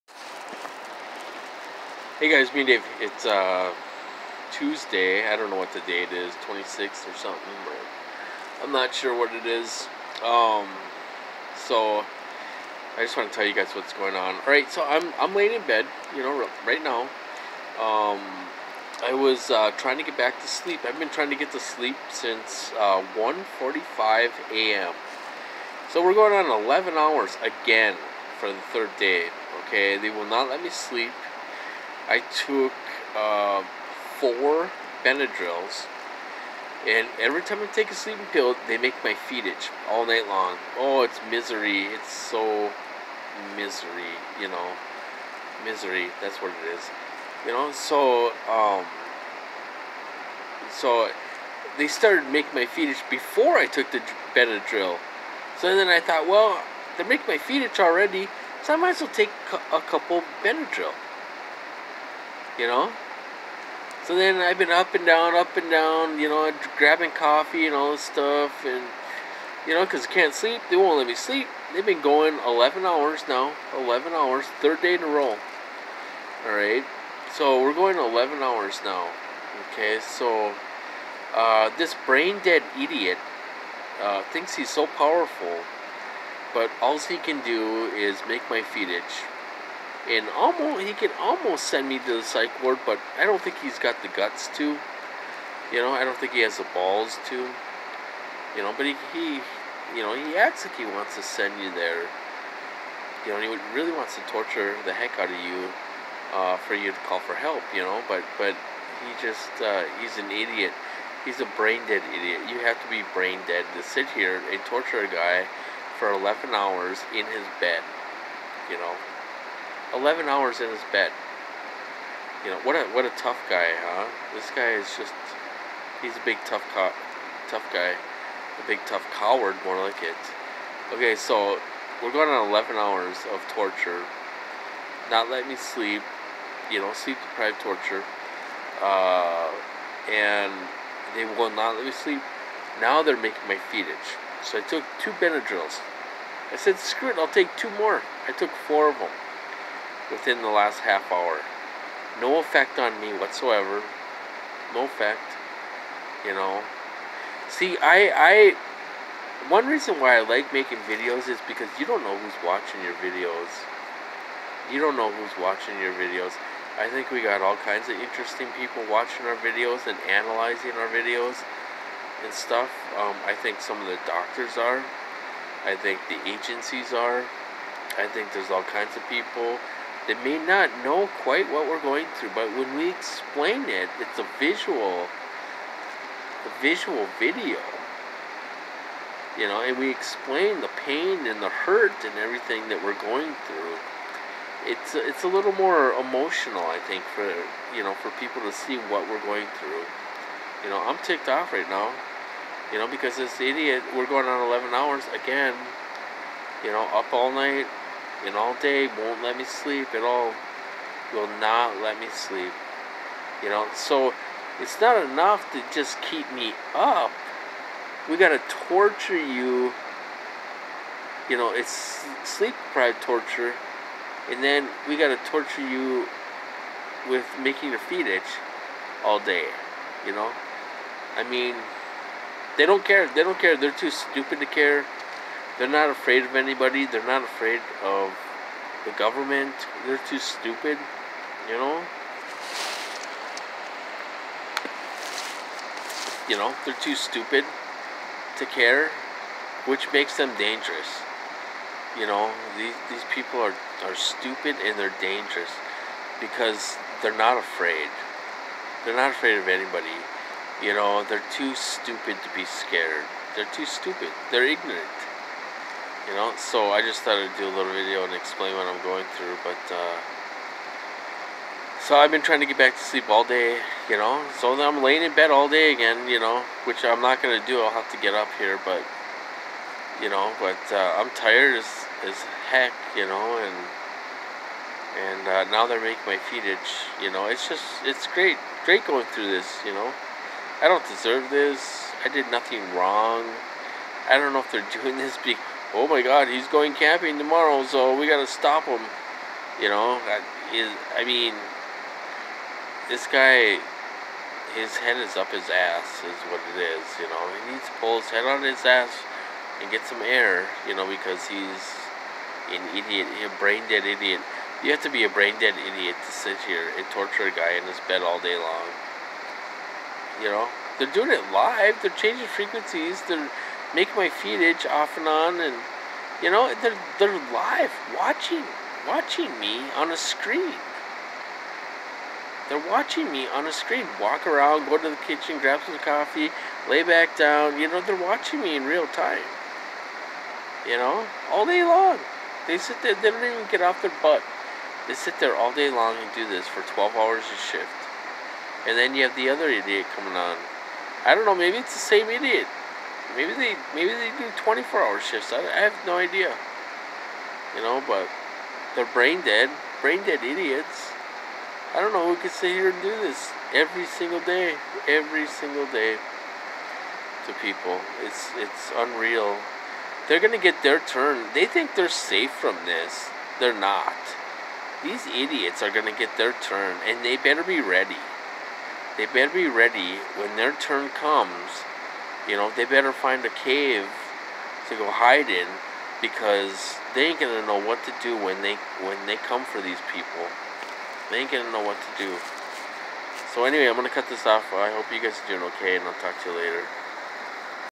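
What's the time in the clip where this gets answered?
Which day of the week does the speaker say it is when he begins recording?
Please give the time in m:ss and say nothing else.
0:04.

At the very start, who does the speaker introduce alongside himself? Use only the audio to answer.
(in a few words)
Dave.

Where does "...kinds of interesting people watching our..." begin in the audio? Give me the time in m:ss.
2:47.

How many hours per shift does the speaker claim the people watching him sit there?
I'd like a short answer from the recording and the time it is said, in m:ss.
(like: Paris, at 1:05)
12, at 5:46.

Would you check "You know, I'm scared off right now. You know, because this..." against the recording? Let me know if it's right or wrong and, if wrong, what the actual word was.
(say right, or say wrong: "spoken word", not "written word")
wrong: "ticked", not "scared".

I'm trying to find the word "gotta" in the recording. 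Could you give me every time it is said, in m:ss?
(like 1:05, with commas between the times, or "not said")
3:38, 3:44.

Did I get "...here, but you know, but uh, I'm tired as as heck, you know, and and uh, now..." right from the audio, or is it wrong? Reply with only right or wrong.
right.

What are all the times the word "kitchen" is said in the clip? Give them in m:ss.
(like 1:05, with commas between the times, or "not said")
5:35.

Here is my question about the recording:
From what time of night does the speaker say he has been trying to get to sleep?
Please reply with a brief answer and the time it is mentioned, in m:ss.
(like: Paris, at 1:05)
1:45 a.m., at 0:23.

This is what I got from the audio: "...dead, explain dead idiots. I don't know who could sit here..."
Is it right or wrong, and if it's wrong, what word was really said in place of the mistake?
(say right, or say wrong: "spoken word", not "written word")
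wrong: "brain", not "explain".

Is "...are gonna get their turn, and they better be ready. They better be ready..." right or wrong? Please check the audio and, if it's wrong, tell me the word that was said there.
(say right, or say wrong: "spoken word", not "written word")
right.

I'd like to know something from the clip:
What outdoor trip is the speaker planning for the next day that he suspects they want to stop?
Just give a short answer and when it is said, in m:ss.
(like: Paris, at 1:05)
Camping, at 4:56.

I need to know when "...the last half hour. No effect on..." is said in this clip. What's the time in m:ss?
2:30.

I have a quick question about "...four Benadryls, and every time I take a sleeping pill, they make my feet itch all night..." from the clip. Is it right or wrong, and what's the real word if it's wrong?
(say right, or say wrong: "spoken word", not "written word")
right.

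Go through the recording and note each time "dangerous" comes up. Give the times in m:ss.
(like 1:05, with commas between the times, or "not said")
4:10, 4:14.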